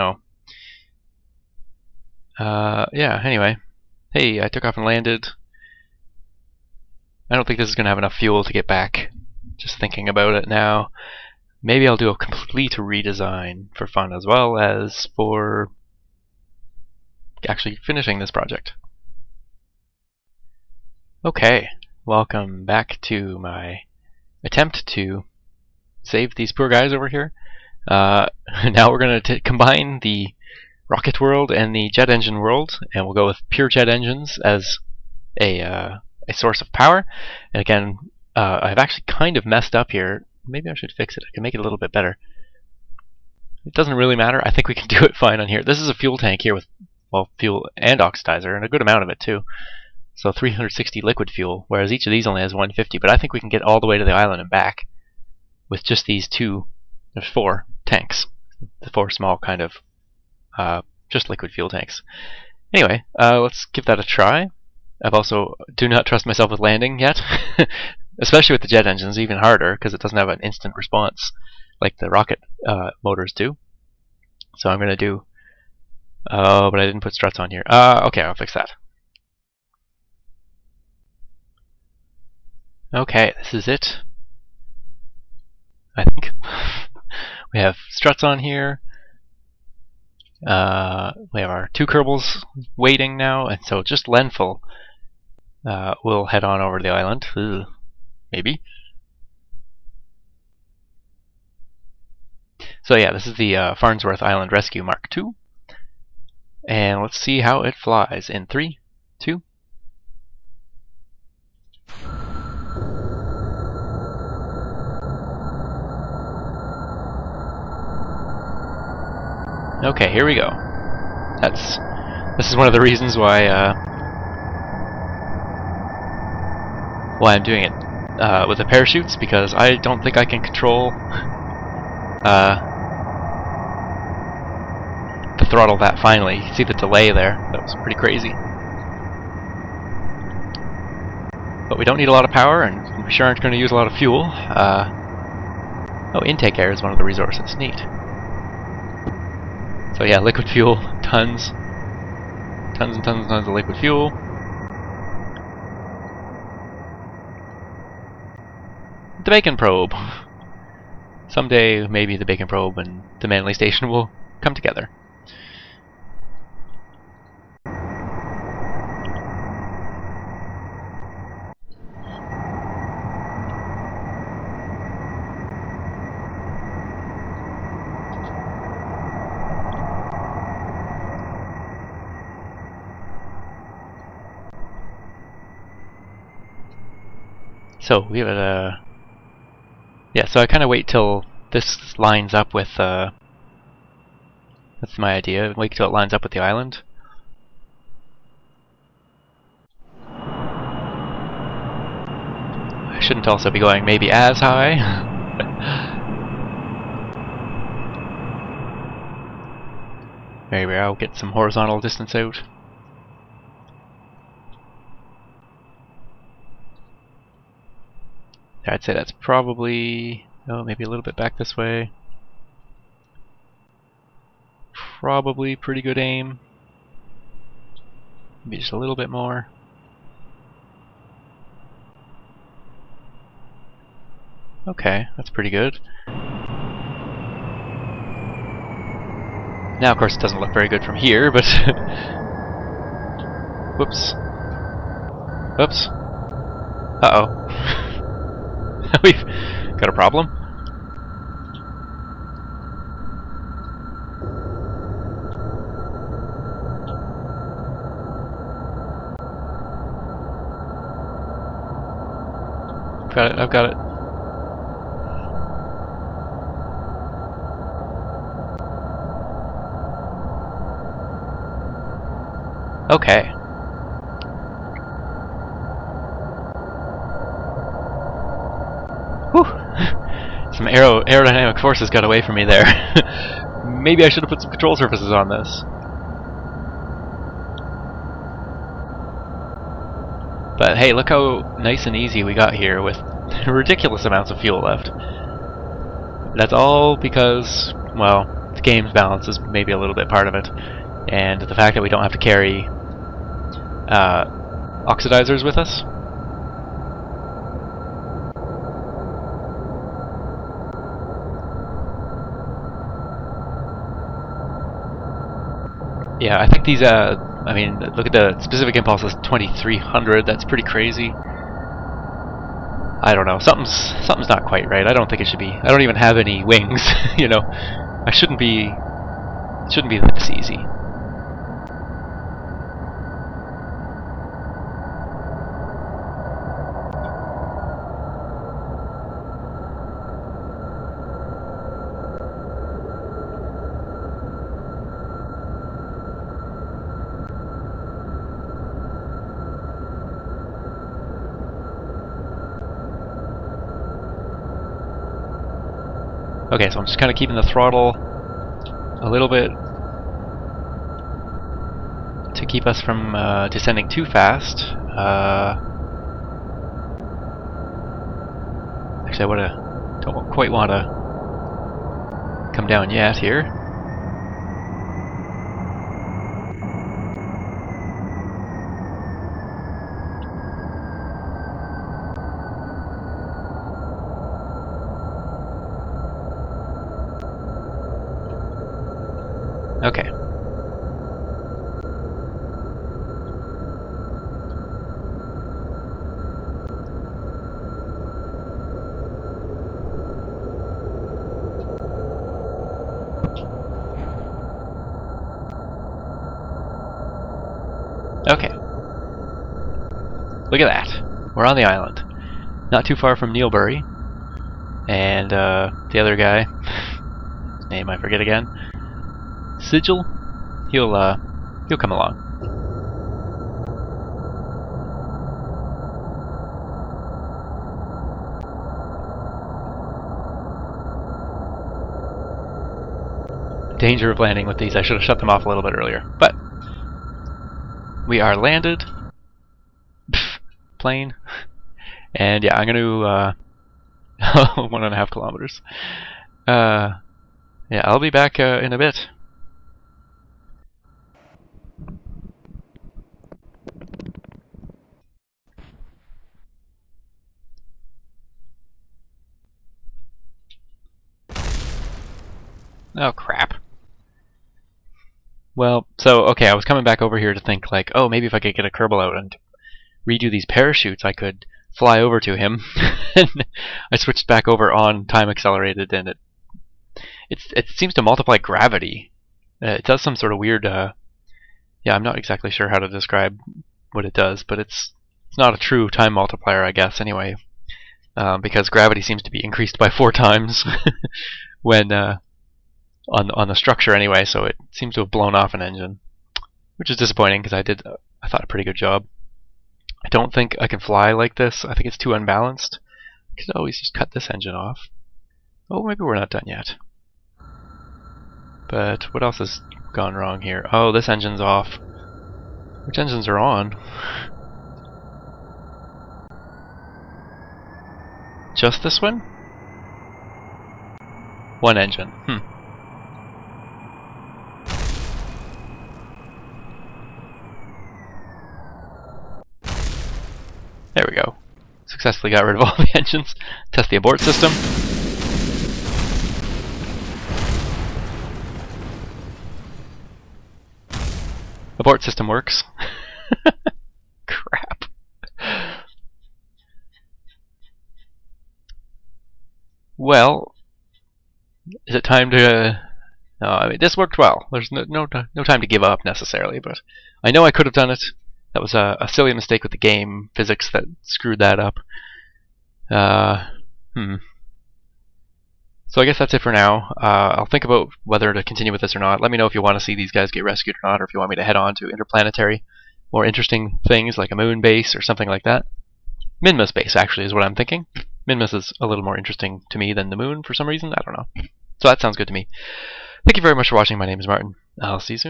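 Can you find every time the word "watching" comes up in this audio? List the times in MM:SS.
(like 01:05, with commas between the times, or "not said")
09:43.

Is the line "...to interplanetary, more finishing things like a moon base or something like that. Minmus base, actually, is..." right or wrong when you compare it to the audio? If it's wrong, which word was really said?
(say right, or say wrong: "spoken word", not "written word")
wrong: "interesting", not "finishing".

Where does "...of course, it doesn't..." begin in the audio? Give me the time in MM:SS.
03:59.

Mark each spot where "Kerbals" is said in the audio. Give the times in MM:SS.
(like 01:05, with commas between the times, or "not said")
01:31, 07:48.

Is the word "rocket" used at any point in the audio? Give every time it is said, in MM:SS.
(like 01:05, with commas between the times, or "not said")
00:30, 01:12.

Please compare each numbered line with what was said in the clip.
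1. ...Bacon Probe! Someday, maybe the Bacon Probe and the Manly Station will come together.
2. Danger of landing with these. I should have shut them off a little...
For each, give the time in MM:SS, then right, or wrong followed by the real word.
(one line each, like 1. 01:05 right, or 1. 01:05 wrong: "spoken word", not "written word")
1. 02:39 right
2. 07:13 right.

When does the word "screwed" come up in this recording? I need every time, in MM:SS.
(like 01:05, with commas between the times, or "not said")
09:21.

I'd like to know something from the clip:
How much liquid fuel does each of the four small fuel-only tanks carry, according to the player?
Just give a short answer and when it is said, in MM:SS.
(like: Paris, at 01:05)
150, at 00:52.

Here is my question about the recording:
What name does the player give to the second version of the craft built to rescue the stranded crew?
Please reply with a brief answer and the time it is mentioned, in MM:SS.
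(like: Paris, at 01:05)
Farnsworth Island Rescue Mark II, at 01:43.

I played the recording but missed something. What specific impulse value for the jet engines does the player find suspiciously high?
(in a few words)
2300.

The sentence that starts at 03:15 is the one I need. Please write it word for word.
Wait till it lines up with the island.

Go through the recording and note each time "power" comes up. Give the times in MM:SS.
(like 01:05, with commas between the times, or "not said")
00:36, 02:22.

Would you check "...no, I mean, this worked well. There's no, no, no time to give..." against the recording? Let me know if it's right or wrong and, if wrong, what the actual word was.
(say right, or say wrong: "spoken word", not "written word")
right.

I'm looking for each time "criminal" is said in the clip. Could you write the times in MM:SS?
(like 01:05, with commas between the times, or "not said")
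not said.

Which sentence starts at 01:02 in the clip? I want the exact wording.
Anyway, uh, let's give that a try.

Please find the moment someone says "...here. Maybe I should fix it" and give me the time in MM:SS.
00:39.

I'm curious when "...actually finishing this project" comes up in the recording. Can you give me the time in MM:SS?
00:17.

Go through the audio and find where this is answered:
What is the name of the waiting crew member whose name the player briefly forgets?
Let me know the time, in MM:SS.
06:59.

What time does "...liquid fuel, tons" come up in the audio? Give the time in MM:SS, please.
02:30.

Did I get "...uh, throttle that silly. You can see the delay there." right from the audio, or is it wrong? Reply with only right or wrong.
wrong.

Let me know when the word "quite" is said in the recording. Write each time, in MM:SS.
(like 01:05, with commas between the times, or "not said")
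05:24, 06:10.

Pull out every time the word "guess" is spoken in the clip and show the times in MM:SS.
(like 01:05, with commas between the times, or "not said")
08:06, 09:26.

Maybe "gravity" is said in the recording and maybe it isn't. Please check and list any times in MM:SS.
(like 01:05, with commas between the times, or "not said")
07:58, 08:08.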